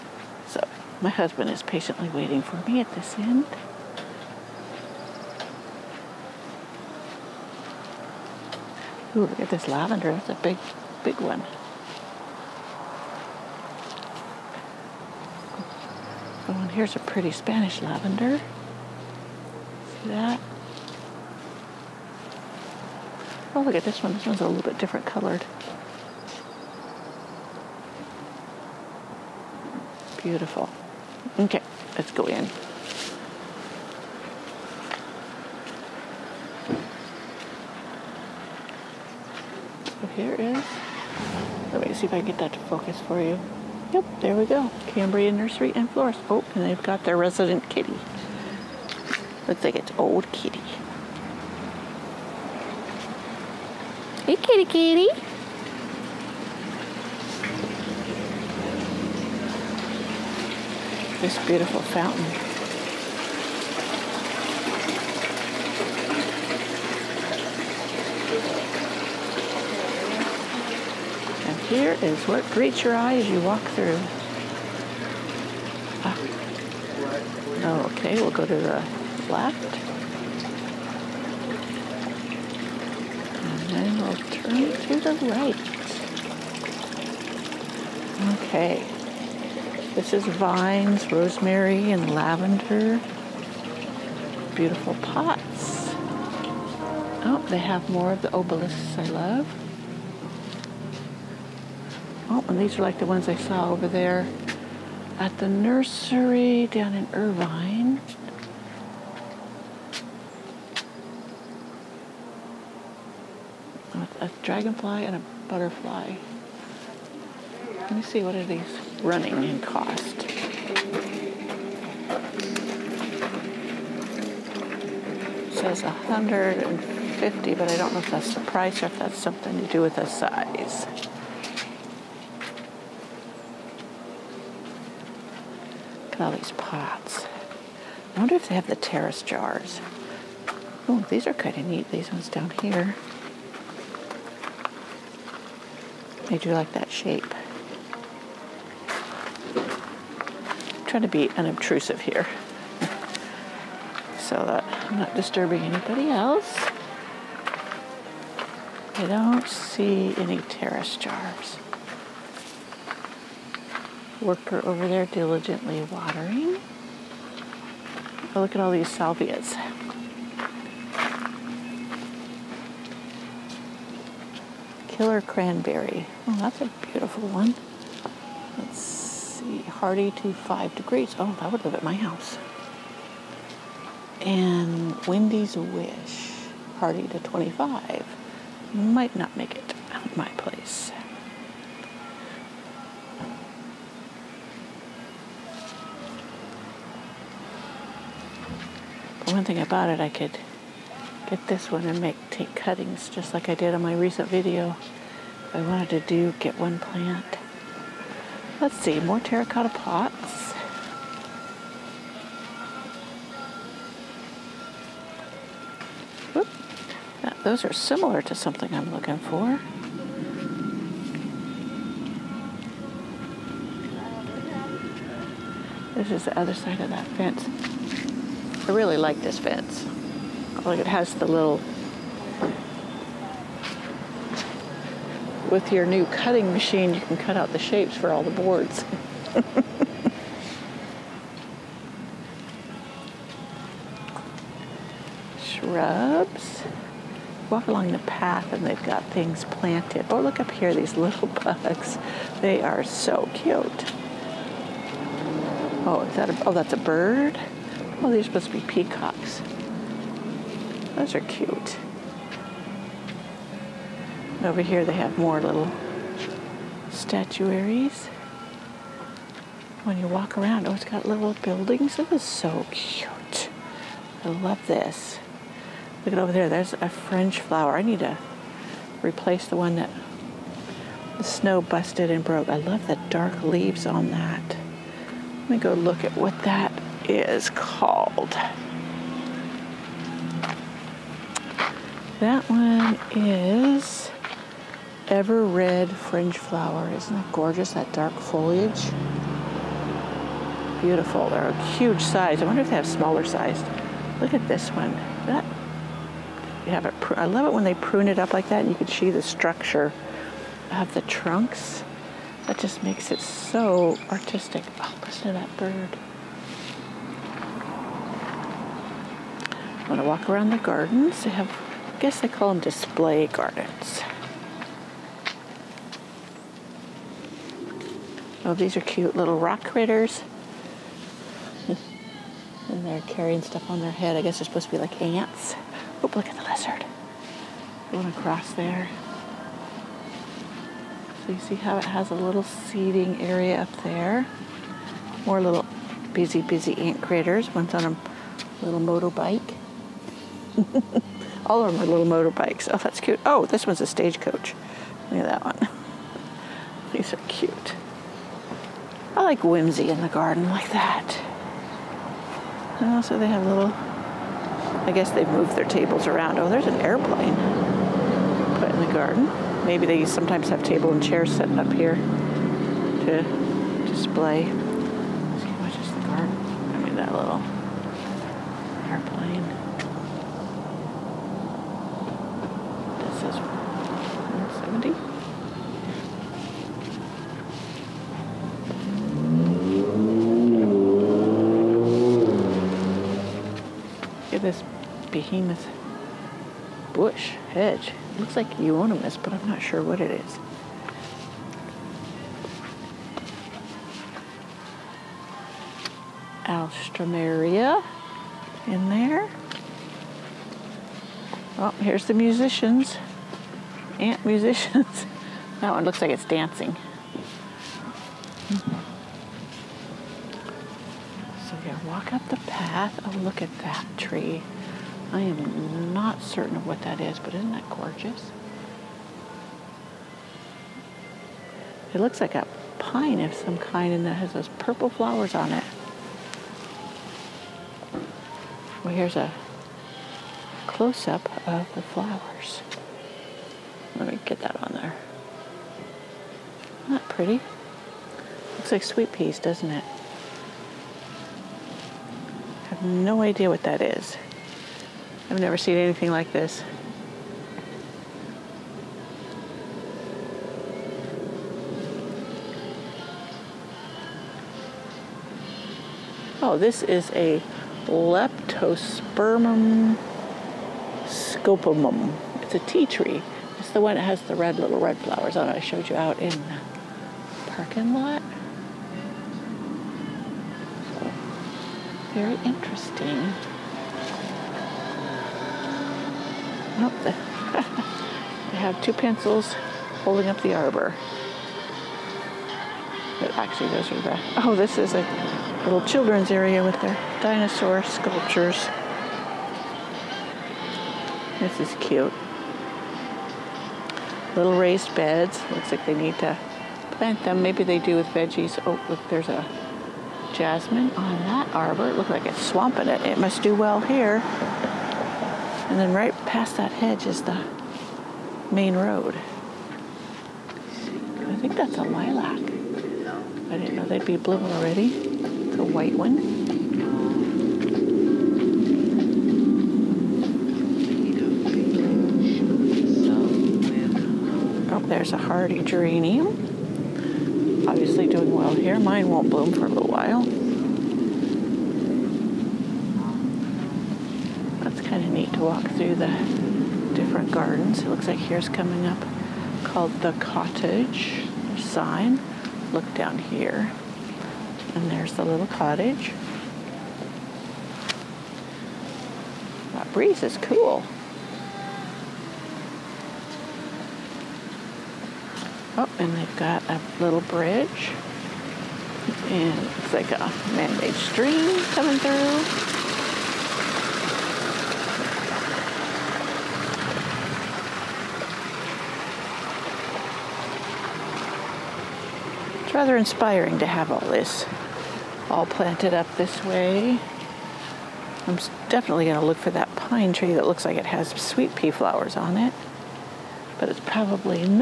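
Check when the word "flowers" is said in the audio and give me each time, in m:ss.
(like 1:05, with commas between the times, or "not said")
4:37, 4:56, 7:14, 7:21, 7:54, 9:51.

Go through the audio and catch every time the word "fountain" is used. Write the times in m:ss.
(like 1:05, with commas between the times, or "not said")
1:01.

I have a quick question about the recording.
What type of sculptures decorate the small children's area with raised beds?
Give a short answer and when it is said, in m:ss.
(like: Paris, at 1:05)
Dinosaur sculptures, at 8:17.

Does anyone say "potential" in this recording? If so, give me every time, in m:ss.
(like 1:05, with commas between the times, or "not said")
not said.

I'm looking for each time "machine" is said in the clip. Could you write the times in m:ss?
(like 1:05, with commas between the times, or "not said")
3:56.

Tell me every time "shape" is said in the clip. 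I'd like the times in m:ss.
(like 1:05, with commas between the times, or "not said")
2:26, 3:57.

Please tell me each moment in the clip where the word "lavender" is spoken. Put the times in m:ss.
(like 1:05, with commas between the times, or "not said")
0:09, 0:17, 1:32.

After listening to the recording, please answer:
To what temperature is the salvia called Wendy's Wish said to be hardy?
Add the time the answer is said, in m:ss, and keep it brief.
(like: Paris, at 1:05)
25, at 3:07.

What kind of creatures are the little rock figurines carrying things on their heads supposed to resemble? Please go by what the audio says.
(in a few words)
Ants.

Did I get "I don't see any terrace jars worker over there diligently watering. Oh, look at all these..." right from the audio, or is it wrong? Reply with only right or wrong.
right.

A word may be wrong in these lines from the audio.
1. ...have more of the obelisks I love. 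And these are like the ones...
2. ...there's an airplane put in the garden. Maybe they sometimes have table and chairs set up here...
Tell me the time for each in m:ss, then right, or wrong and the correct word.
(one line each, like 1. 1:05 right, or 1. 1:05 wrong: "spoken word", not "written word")
1. 1:37 right
2. 6:06 right.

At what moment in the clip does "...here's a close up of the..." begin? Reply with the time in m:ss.
7:18.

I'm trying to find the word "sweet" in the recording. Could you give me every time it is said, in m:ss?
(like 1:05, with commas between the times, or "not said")
7:28, 9:51.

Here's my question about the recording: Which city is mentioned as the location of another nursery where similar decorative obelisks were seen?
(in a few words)
Irvine.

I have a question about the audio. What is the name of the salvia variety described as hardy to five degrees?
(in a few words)
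Killer cranberry.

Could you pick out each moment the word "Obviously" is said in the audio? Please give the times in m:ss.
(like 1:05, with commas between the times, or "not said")
8:57.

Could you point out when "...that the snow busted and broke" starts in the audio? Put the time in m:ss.
4:39.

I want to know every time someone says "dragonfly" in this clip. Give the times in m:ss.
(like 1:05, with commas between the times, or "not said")
1:54.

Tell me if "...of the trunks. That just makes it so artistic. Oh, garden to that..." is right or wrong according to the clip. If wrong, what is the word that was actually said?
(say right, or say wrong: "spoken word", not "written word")
wrong: "listen", not "garden".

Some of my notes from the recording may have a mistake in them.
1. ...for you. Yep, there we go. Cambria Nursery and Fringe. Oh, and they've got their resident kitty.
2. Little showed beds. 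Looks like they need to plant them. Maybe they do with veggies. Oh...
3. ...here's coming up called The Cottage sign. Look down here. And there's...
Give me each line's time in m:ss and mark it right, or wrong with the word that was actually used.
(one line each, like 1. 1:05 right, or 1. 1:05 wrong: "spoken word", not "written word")
1. 0:43 wrong: "Florist", not "Fringe"
2. 8:24 wrong: "raised", not "showed"
3. 9:08 right.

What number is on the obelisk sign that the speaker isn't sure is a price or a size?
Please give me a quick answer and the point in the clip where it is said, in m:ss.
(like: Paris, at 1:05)
150, at 2:05.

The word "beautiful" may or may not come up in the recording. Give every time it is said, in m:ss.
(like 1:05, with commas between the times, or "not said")
0:30, 1:01, 1:34, 2:56, 5:00.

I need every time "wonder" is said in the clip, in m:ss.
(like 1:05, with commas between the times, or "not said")
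2:18, 5:02.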